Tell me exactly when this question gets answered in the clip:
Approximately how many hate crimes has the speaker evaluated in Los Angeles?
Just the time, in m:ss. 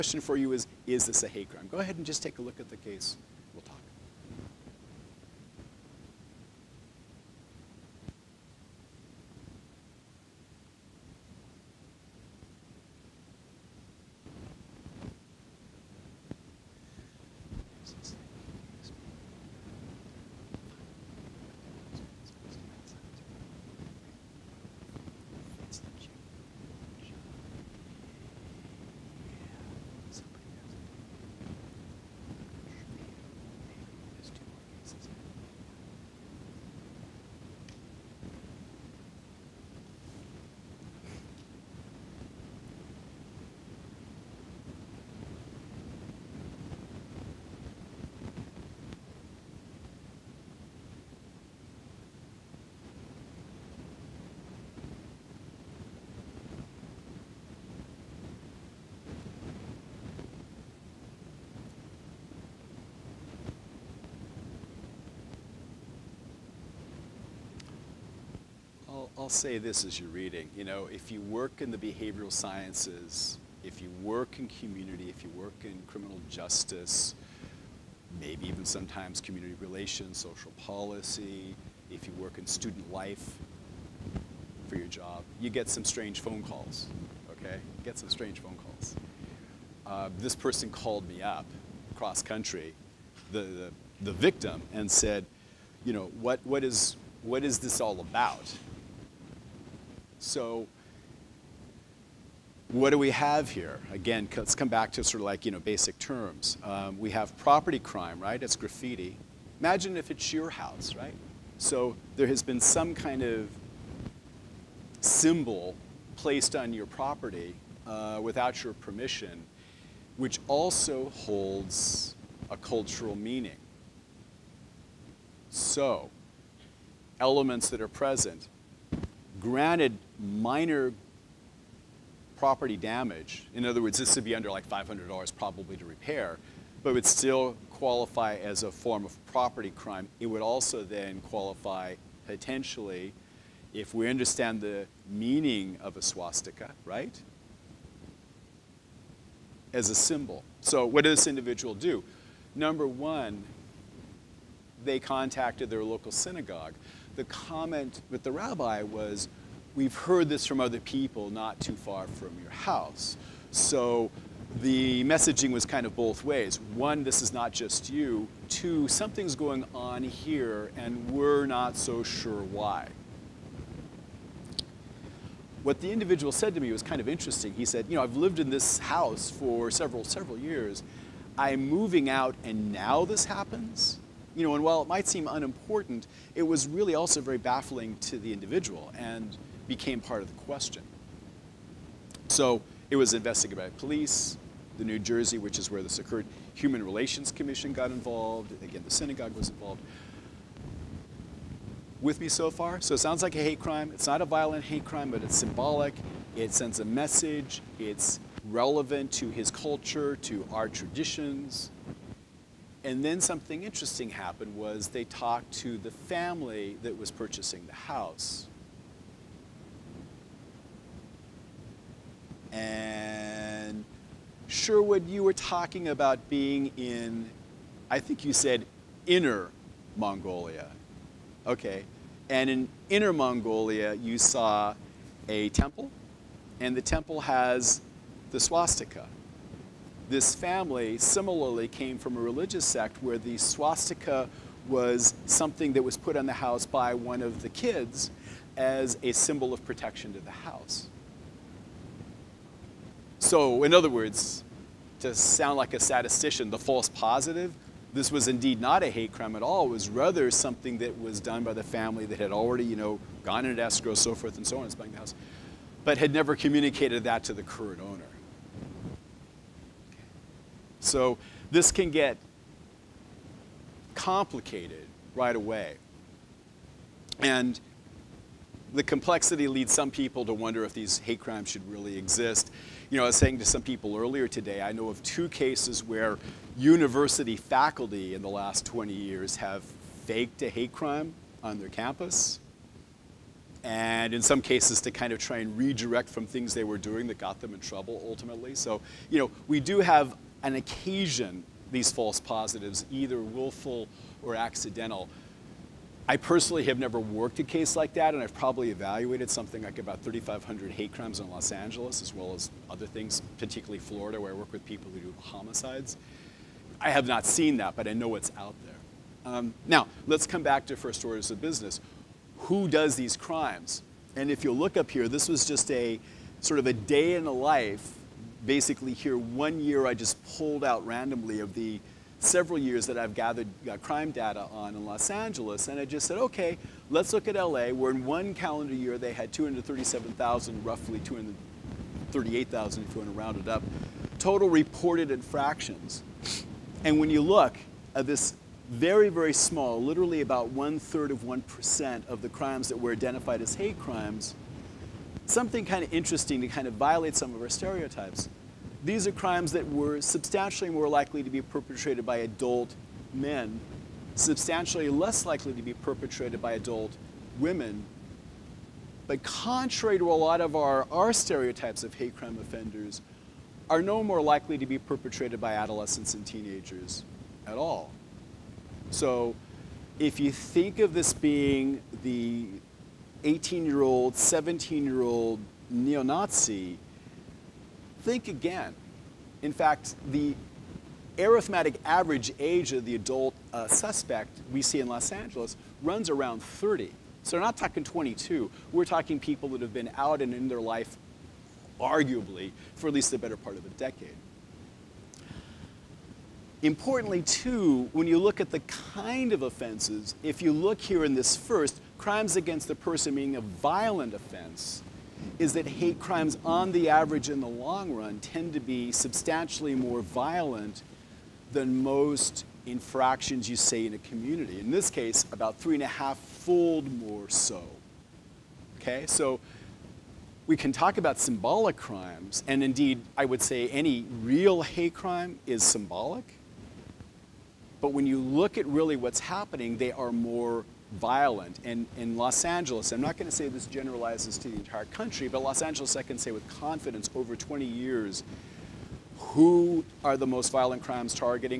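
5:10.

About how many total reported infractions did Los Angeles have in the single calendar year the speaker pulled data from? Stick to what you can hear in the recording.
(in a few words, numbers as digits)
237,000.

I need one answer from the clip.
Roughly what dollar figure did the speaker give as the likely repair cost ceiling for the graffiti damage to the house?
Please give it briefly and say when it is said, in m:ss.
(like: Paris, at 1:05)
$500, at 2:14.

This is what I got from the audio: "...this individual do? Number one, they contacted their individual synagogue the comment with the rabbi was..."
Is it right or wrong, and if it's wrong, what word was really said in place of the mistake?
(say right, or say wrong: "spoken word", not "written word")
wrong: "local", not "individual".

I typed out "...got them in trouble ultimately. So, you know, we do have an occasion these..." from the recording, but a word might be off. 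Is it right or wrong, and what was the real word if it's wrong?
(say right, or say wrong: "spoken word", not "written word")
right.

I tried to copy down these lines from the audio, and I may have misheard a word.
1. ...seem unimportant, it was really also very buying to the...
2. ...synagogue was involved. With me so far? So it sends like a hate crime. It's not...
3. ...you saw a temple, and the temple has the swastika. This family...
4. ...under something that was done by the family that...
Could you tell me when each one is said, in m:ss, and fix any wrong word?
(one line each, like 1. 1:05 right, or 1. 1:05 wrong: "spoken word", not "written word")
1. 3:05 wrong: "baffling", not "buying"
2. 3:18 wrong: "sounds", not "sends"
3. 3:53 right
4. 4:19 wrong: "rather", not "under".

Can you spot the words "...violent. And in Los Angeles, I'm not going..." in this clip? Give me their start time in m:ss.
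7:20.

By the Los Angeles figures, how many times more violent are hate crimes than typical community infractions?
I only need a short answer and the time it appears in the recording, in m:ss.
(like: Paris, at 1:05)
3.5 times, at 7:05.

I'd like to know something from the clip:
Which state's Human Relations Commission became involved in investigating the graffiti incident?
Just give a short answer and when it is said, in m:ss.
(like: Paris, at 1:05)
New Jersey, at 3:14.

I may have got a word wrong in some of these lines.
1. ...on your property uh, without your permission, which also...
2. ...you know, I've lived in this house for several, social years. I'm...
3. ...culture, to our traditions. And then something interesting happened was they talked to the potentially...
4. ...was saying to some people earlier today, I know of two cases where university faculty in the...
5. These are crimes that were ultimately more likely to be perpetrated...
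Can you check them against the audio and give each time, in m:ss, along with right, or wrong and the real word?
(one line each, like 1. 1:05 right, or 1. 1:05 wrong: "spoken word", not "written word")
1. 1:56 right
2. 2:57 wrong: "several", not "social"
3. 3:29 wrong: "family", not "potentially"
4. 4:43 right
5. 5:58 wrong: "substantially", not "ultimately".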